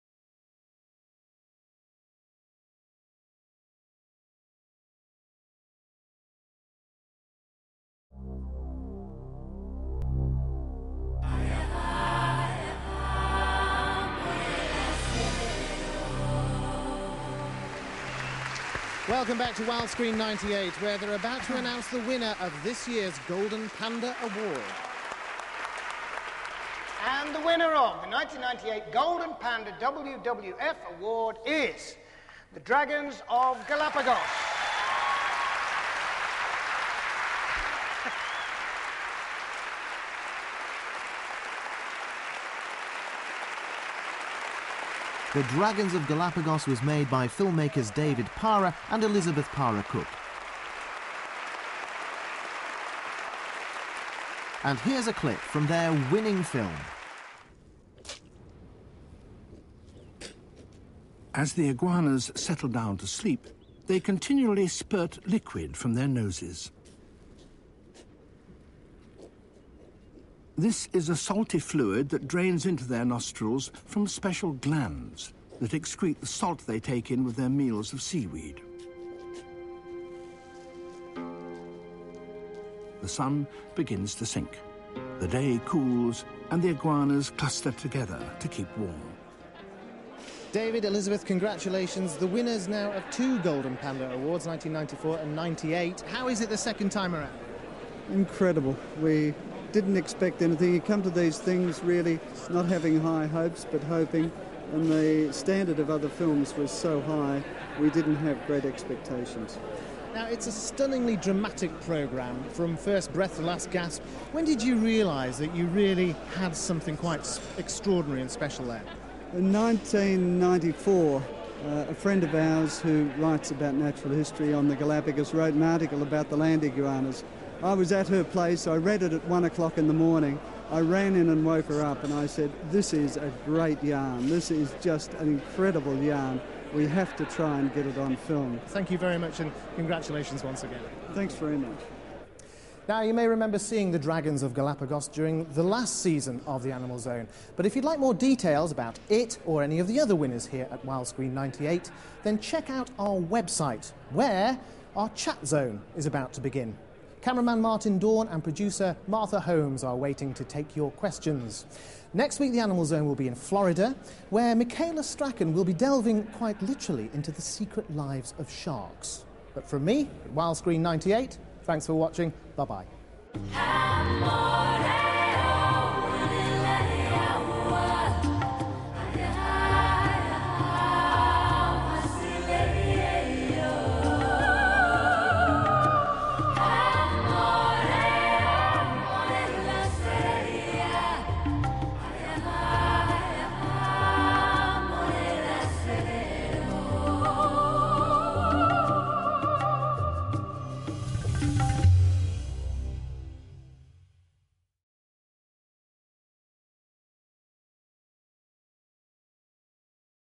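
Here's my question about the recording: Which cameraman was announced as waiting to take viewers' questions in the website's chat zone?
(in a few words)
Martin Dohrn.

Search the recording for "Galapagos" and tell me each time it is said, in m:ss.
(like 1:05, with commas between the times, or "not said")
0:33, 0:46, 2:04, 2:24.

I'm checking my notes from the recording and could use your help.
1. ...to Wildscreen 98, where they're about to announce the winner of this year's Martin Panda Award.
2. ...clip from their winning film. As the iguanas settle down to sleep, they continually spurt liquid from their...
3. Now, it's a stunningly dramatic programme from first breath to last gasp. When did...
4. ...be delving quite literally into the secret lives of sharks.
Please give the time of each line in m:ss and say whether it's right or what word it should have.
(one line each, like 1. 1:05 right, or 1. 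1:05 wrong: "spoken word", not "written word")
1. 0:19 wrong: "Golden", not "Martin"
2. 0:55 right
3. 1:50 right
4. 2:45 right.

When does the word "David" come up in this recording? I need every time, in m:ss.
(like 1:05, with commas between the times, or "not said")
0:47, 1:30.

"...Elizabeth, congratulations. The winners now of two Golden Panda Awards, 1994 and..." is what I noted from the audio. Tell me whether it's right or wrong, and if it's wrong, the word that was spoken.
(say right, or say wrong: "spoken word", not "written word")
right.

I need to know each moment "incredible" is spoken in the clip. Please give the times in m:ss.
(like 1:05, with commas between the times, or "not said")
1:38, 2:15.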